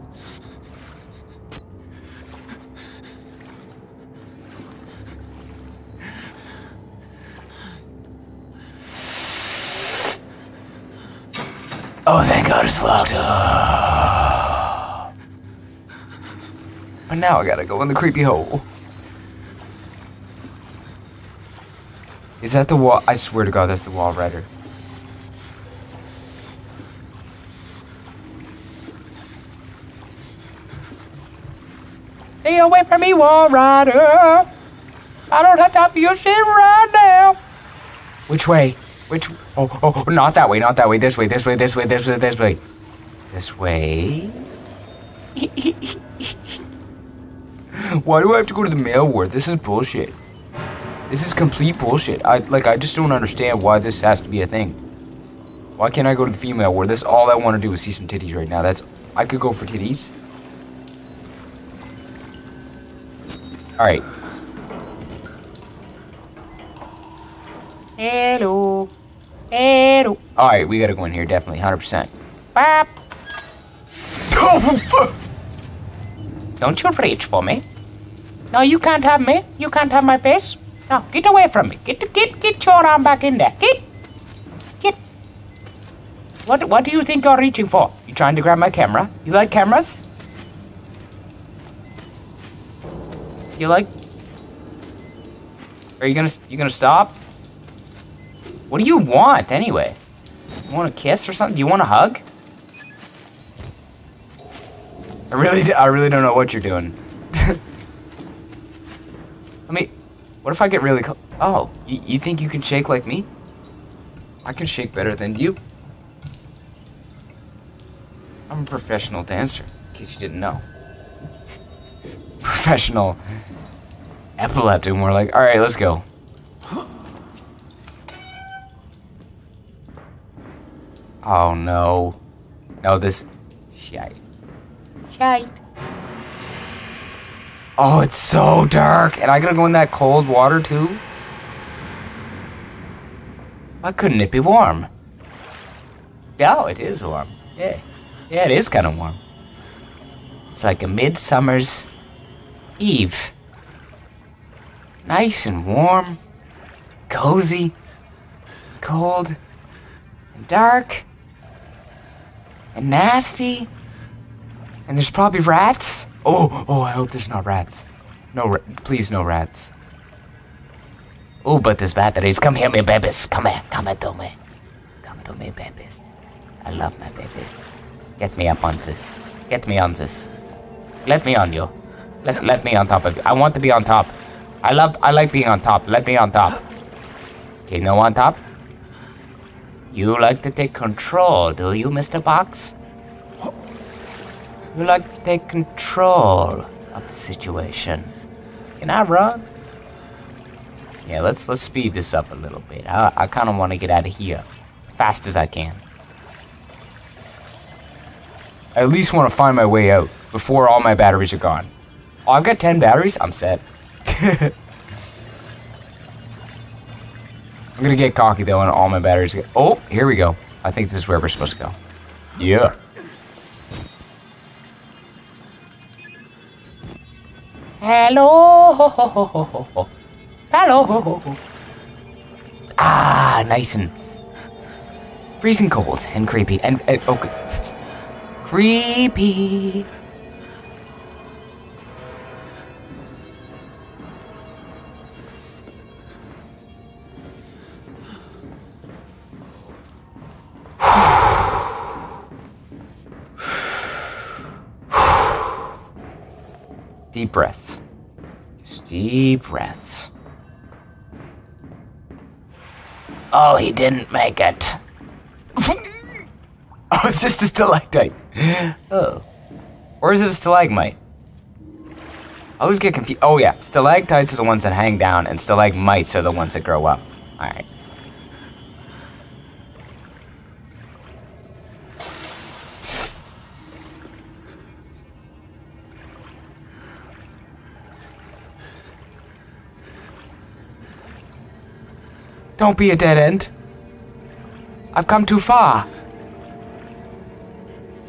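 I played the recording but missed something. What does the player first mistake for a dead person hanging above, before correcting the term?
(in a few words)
A stalactite.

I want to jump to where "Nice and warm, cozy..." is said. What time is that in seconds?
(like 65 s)
155 s.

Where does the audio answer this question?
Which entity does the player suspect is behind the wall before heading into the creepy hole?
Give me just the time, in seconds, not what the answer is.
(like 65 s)
23 s.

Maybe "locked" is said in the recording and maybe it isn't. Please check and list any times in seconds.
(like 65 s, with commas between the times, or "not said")
12 s.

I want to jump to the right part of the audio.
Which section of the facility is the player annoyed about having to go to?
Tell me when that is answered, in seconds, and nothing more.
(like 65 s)
48 s.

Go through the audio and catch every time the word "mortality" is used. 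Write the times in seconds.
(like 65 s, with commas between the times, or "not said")
not said.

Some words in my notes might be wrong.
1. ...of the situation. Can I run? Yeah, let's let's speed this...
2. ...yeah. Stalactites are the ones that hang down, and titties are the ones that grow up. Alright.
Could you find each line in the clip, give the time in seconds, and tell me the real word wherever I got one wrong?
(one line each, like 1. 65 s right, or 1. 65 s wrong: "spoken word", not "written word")
1. 196 s right
2. 273 s wrong: "stalagmites", not "titties".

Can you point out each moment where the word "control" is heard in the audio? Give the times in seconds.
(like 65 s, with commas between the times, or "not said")
190 s, 195 s.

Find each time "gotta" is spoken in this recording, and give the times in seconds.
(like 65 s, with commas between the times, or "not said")
17 s, 70 s, 139 s.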